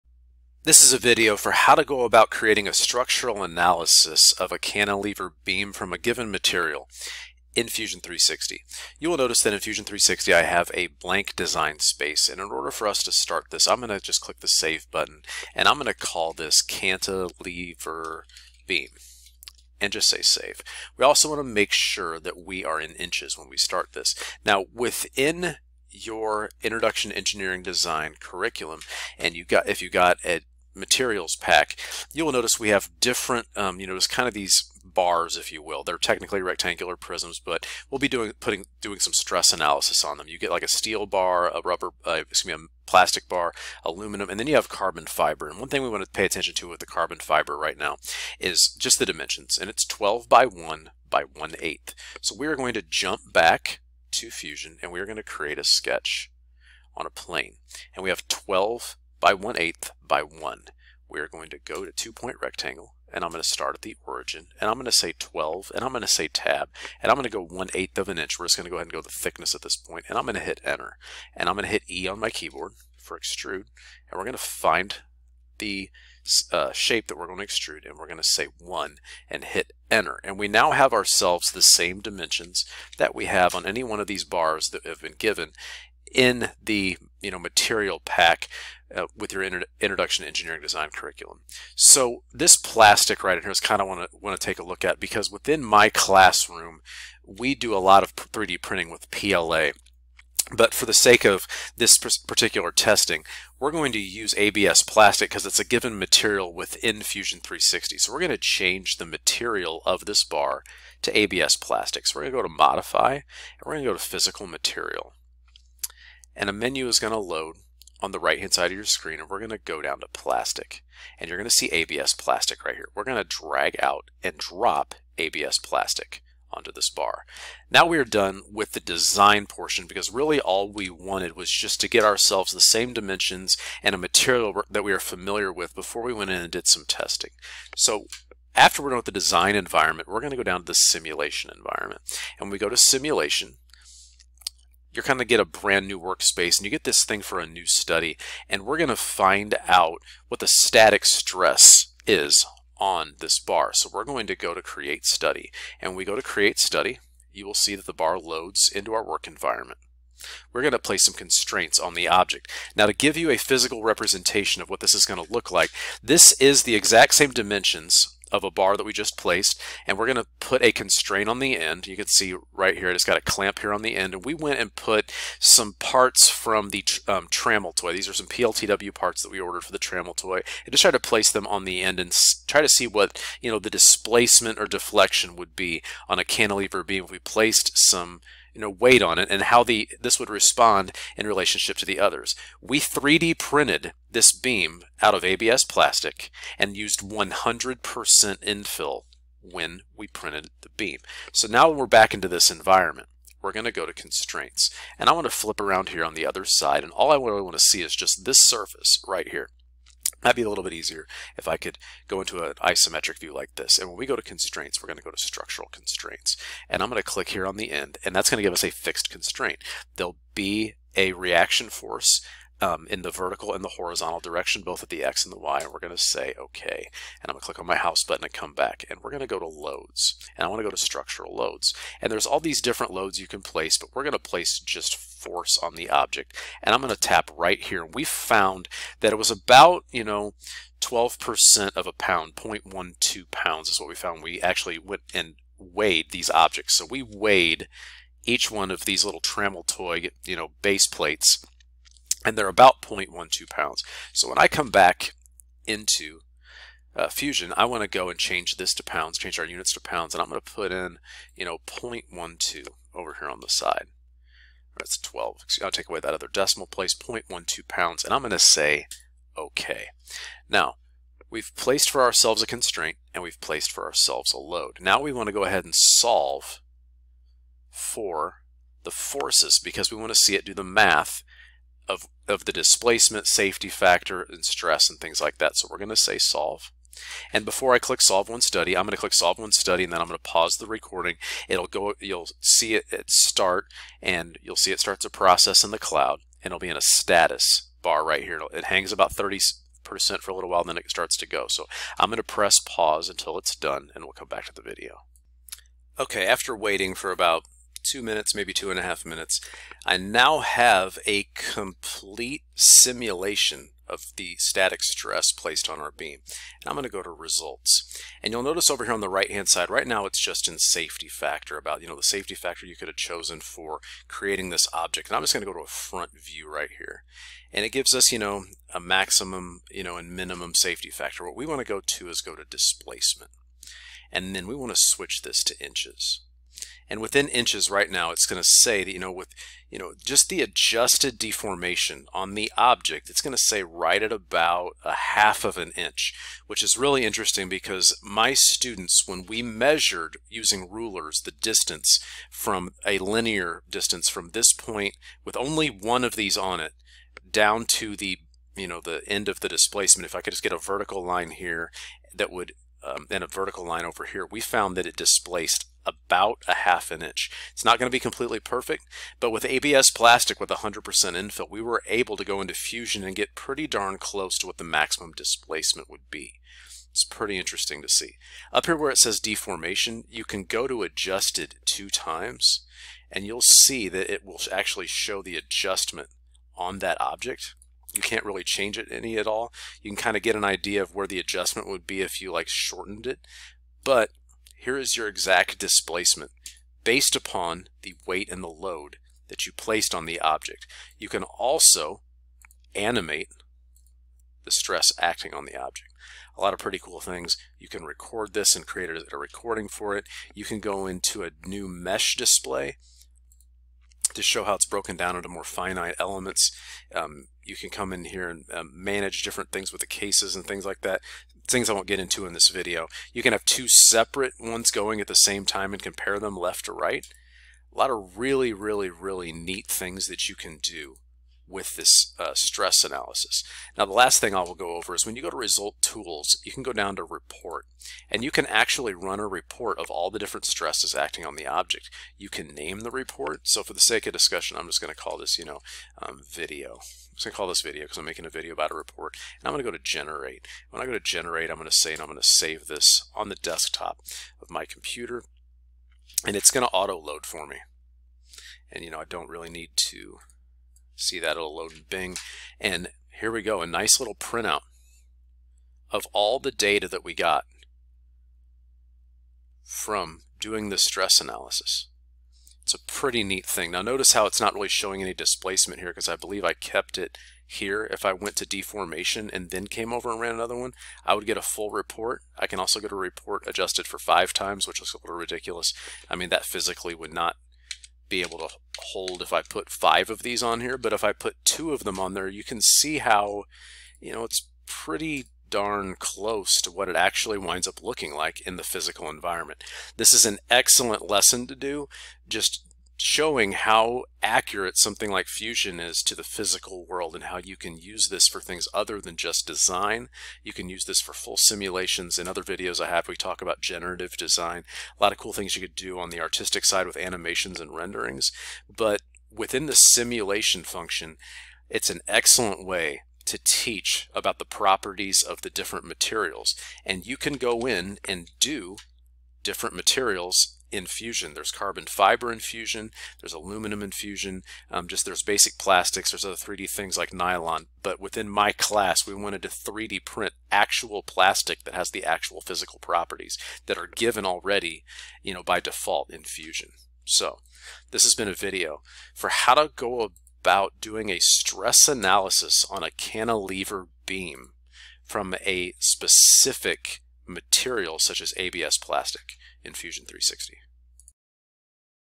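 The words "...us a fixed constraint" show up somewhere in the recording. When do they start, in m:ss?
3:38.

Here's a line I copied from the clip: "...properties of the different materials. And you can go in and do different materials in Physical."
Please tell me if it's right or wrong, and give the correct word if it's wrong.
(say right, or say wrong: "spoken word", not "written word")
wrong: "Fusion", not "Physical".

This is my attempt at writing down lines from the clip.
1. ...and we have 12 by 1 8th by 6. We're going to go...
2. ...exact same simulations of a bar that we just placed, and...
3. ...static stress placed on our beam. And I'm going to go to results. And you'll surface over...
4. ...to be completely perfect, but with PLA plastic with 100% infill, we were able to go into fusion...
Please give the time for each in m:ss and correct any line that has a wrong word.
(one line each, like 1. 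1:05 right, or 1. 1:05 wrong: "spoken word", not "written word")
1. 0:57 wrong: "1", not "6"
2. 2:46 wrong: "dimensions", not "simulations"
3. 5:14 wrong: "notice", not "surface"
4. 6:07 wrong: "ABS", not "PLA".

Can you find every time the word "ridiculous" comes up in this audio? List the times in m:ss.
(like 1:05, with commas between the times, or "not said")
8:05.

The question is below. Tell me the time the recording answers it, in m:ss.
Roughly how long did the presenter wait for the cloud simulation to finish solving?
5:07.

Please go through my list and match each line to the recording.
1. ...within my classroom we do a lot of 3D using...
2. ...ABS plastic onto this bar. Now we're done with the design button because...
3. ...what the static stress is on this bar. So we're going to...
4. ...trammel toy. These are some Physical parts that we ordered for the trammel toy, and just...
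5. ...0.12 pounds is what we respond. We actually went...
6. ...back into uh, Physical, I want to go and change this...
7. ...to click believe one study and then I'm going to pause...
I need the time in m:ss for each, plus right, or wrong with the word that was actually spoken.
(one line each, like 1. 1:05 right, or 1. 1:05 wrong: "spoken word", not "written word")
1. 1:35 wrong: "printing", not "using"
2. 2:05 wrong: "portion", not "button"
3. 2:30 right
4. 2:57 wrong: "PLTW", not "Physical"
5. 4:02 wrong: "found", not "respond"
6. 4:14 wrong: "Fusion", not "Physical"
7. 4:48 wrong: "solve", not "believe".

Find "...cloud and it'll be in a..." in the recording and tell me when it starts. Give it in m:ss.
4:55.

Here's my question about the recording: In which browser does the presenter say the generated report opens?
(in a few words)
Bing.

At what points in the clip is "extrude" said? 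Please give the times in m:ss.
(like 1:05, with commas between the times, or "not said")
1:13, 1:17.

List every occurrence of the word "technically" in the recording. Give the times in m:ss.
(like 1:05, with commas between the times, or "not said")
0:35.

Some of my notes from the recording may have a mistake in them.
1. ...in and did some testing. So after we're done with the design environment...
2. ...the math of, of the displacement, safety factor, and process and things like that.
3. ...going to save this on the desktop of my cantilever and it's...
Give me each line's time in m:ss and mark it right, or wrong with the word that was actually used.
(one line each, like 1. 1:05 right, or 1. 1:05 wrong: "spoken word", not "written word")
1. 2:16 right
2. 4:40 wrong: "stress", not "process"
3. 7:32 wrong: "computer", not "cantilever".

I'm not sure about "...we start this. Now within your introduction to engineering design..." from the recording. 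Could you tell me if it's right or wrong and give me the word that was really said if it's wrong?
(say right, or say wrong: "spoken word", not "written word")
right.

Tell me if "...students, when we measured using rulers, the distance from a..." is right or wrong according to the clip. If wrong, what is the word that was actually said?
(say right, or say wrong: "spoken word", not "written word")
right.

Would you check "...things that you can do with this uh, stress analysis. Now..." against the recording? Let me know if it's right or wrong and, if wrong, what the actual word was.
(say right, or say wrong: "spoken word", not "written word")
right.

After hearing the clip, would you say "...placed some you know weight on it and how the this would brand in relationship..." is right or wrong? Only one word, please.
wrong.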